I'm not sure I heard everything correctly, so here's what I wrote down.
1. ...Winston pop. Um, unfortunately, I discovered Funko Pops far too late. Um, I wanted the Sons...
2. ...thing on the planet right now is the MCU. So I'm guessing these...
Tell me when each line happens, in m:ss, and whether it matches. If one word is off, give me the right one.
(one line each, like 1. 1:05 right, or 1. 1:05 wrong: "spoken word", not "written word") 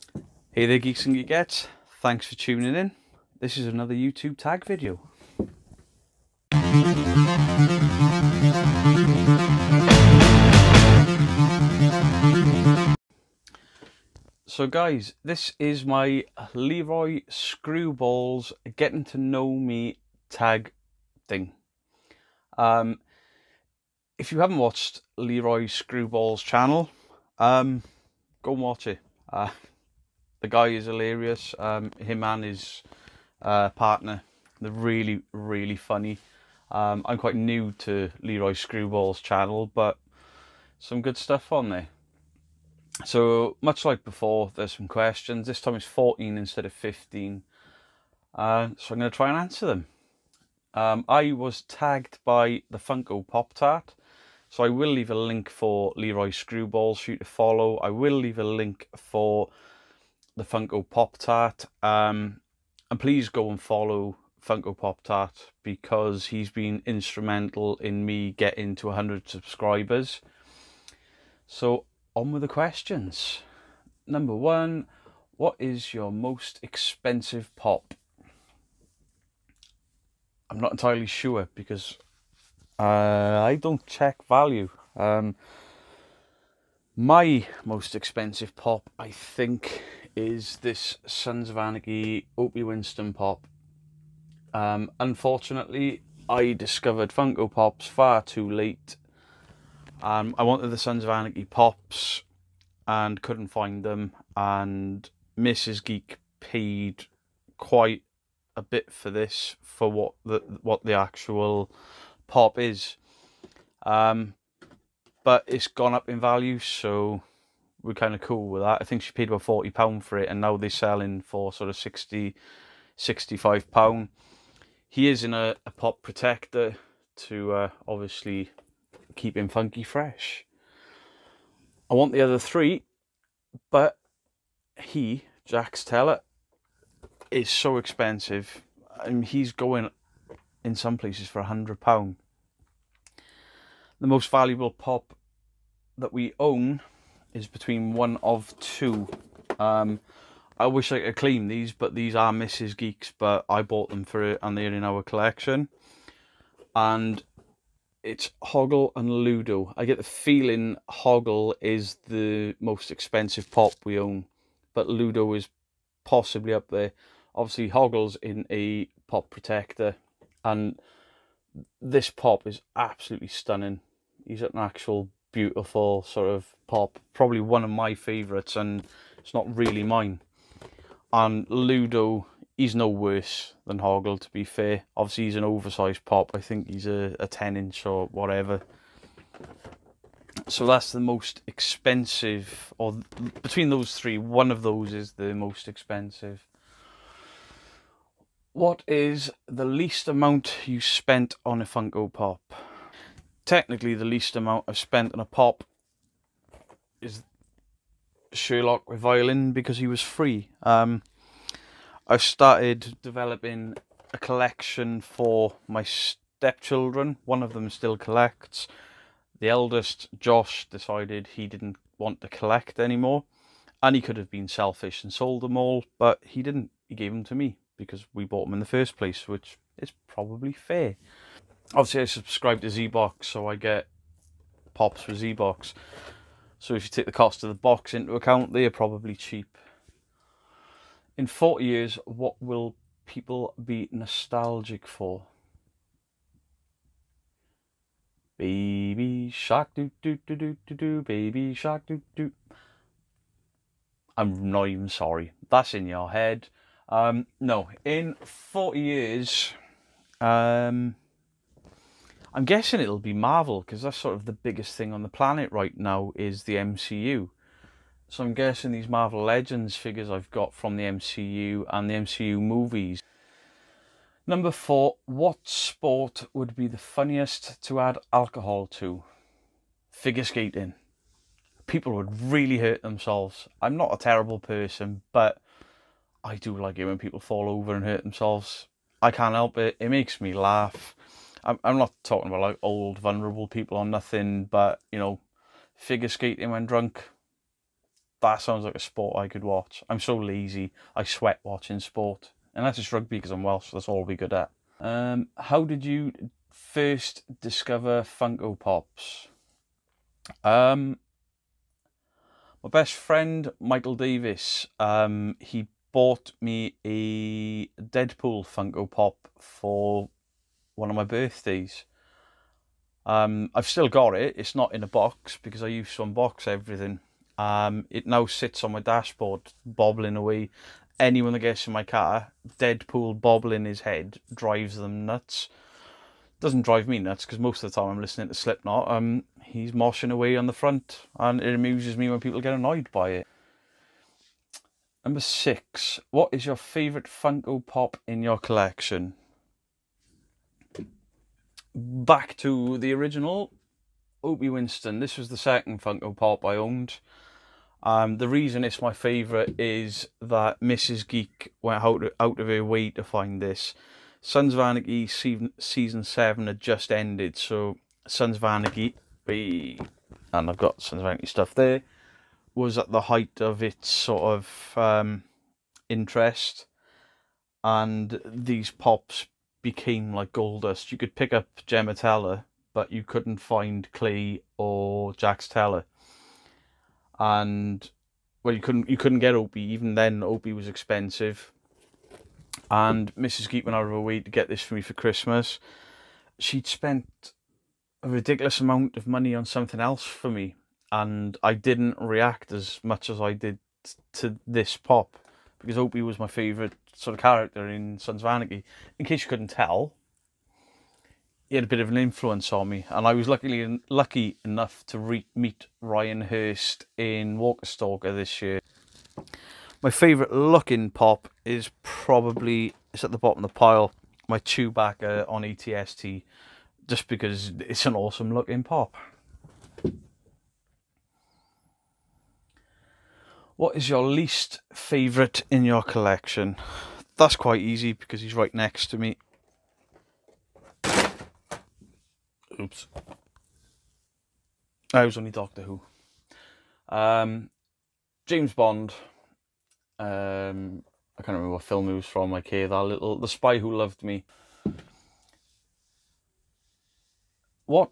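1. 1:32 right
2. 4:24 right.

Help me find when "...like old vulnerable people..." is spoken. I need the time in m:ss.
4:52.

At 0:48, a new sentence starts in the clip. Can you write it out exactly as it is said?
Uh, so, I'm going to try and answer them.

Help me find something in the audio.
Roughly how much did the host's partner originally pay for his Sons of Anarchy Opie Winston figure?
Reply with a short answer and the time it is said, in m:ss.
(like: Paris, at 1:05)
40 pounds, at 1:59.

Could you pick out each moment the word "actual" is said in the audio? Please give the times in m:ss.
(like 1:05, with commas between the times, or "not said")
1:50, 2:54.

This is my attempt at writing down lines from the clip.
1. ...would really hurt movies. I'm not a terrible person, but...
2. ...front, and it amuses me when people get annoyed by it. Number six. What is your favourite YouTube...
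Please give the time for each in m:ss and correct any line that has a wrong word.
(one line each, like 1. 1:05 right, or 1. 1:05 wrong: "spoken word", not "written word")
1. 4:41 wrong: "themselves", not "movies"
2. 5:40 wrong: "Funko", not "YouTube".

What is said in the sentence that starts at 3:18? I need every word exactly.
What is the least amount you spent on a Funko Pop?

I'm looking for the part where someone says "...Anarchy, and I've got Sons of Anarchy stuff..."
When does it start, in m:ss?
6:08.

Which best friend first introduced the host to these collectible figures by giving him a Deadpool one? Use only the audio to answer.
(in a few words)
Michael Davis.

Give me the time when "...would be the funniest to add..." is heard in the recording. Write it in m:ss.
4:36.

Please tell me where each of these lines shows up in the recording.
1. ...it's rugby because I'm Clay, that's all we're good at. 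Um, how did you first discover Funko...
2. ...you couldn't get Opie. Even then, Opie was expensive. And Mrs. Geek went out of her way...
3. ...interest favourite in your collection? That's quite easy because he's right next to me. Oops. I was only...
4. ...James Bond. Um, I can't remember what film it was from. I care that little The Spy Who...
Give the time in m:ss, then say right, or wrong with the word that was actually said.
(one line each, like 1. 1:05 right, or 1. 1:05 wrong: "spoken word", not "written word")
1. 5:02 wrong: "Welsh", not "Clay"
2. 6:28 right
3. 7:14 wrong: "least", not "interest"
4. 7:28 right.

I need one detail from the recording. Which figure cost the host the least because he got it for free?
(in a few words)
Sherlock with violin.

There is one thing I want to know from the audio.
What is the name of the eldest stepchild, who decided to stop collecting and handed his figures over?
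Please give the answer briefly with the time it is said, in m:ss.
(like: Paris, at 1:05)
Josh, at 3:40.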